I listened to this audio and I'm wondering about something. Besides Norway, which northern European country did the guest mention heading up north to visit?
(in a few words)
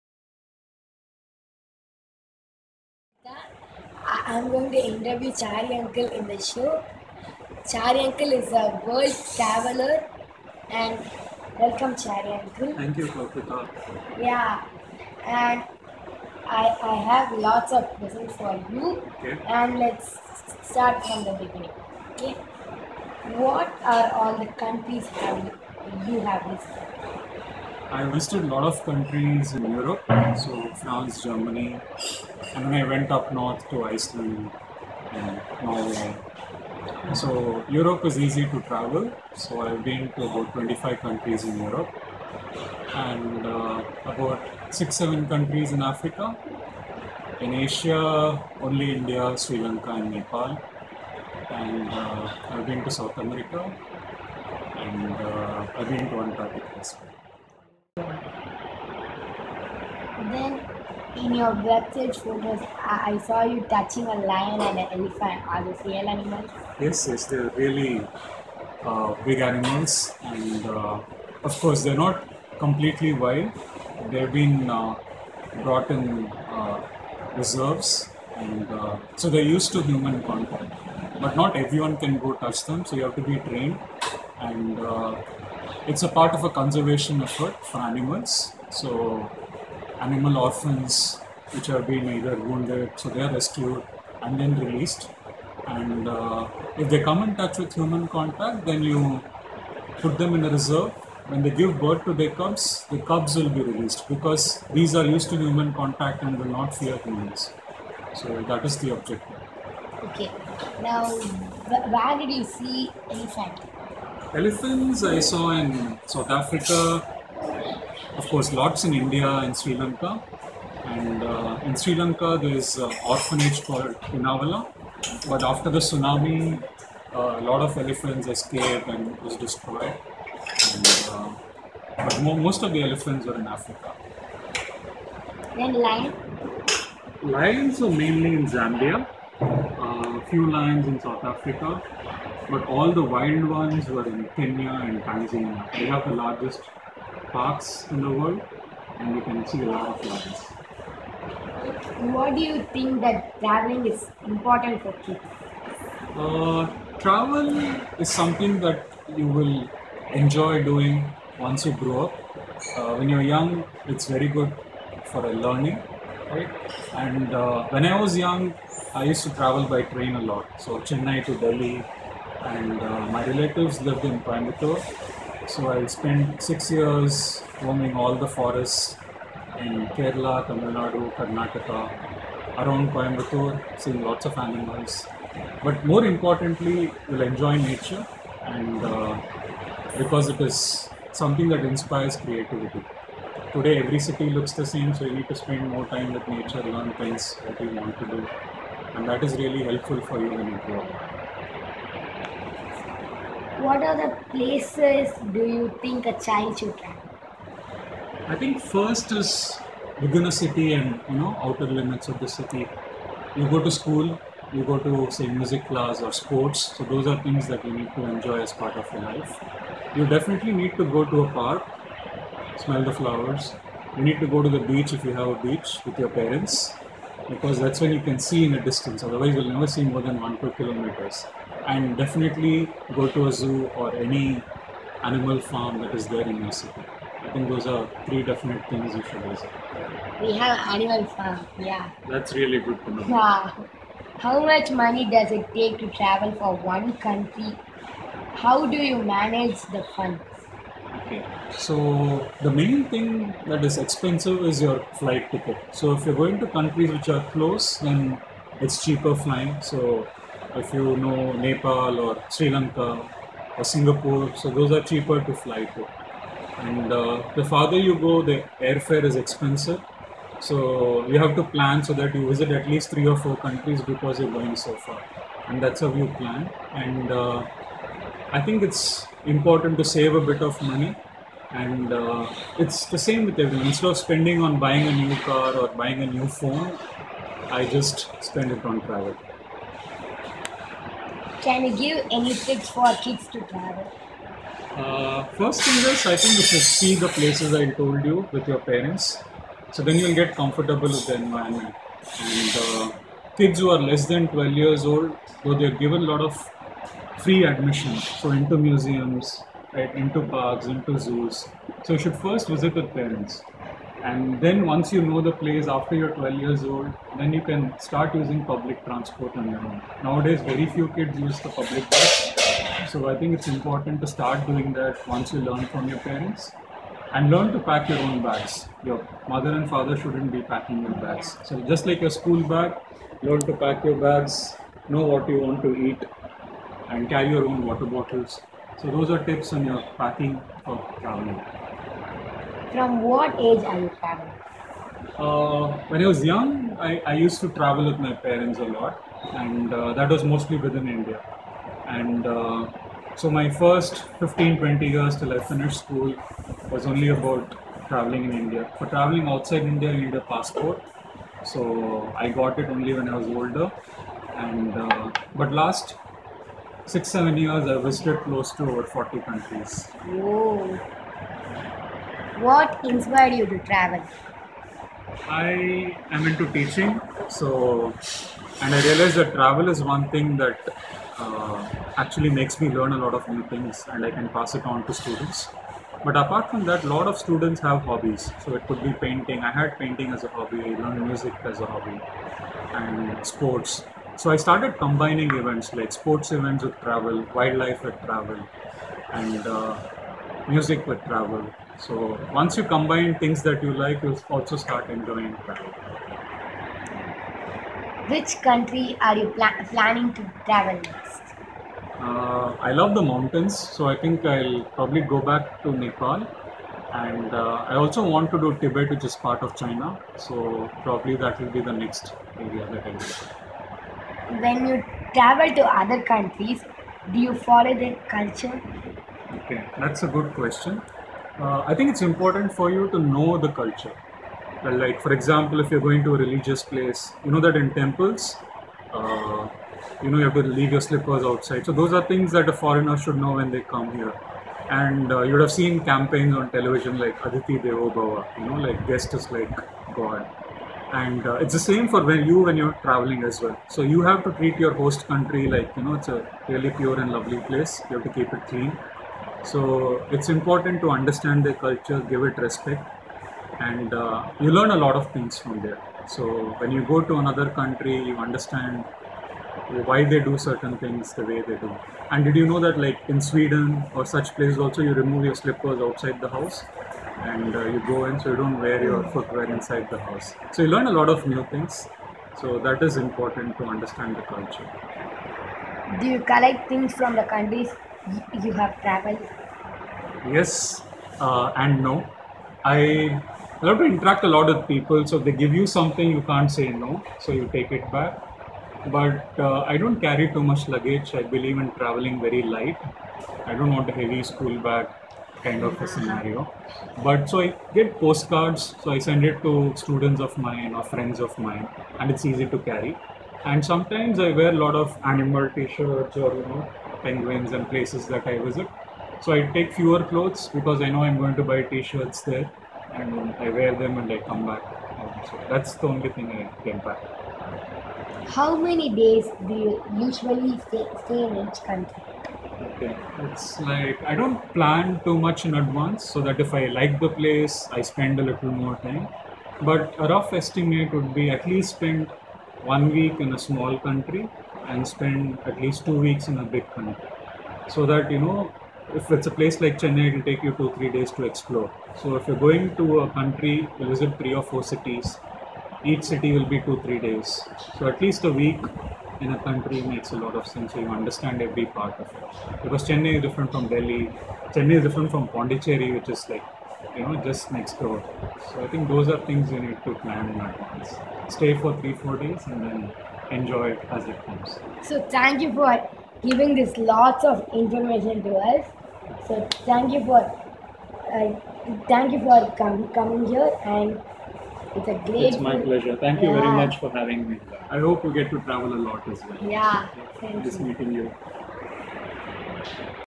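Iceland.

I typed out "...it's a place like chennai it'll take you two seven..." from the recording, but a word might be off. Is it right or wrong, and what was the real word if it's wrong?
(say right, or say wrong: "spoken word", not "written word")
wrong: "three", not "seven".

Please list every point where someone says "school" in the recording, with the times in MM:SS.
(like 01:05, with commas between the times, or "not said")
03:33, 05:32, 05:55, 08:24.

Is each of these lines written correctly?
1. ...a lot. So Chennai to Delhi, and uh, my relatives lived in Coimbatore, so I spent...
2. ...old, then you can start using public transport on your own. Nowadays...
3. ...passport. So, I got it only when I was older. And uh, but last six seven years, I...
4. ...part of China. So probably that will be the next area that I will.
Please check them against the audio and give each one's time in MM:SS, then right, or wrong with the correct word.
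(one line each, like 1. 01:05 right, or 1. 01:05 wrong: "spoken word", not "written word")
1. 02:50 right
2. 05:16 right
3. 06:00 right
4. 06:59 right.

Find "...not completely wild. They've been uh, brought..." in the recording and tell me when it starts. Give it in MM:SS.
01:12.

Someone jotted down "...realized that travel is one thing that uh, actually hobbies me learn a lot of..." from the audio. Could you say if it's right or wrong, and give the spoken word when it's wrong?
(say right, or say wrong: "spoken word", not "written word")
wrong: "makes", not "hobbies".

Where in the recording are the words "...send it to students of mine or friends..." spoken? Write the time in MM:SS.
08:28.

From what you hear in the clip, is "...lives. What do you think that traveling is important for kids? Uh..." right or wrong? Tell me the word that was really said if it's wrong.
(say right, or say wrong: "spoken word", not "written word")
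right.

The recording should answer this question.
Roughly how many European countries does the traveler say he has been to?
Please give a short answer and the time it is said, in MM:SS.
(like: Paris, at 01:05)
25, at 00:40.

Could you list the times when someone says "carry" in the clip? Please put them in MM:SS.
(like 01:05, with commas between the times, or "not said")
05:37, 08:19, 08:32.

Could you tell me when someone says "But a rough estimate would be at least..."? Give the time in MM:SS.
08:59.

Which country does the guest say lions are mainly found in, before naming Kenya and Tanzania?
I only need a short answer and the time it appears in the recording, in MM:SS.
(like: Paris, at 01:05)
Zambia, at 02:18.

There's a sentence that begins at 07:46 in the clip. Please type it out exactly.
So when you go to another country, you understand why they do certain things the way they do.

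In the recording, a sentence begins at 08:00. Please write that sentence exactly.
So you learn a lot of new things.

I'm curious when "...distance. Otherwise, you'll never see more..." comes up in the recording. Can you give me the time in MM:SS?
03:48.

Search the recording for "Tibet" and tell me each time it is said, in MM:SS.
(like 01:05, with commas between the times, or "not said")
06:58.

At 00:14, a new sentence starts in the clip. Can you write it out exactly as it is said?
Yeah, and I, I have lots of presents for you.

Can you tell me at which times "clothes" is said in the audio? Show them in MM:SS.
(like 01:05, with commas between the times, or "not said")
08:40.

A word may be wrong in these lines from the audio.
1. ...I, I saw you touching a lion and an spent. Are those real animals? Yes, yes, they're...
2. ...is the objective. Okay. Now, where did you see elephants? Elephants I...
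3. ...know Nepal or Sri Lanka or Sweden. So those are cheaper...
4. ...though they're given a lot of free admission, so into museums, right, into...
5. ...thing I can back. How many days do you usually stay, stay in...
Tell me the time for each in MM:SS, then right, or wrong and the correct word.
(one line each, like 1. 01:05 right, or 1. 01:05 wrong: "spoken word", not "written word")
1. 01:02 wrong: "elephant", not "spent"
2. 01:48 right
3. 04:20 wrong: "Singapore", not "Sweden"
4. 05:05 right
5. 08:46 right.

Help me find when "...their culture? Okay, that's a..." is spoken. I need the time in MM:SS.
07:07.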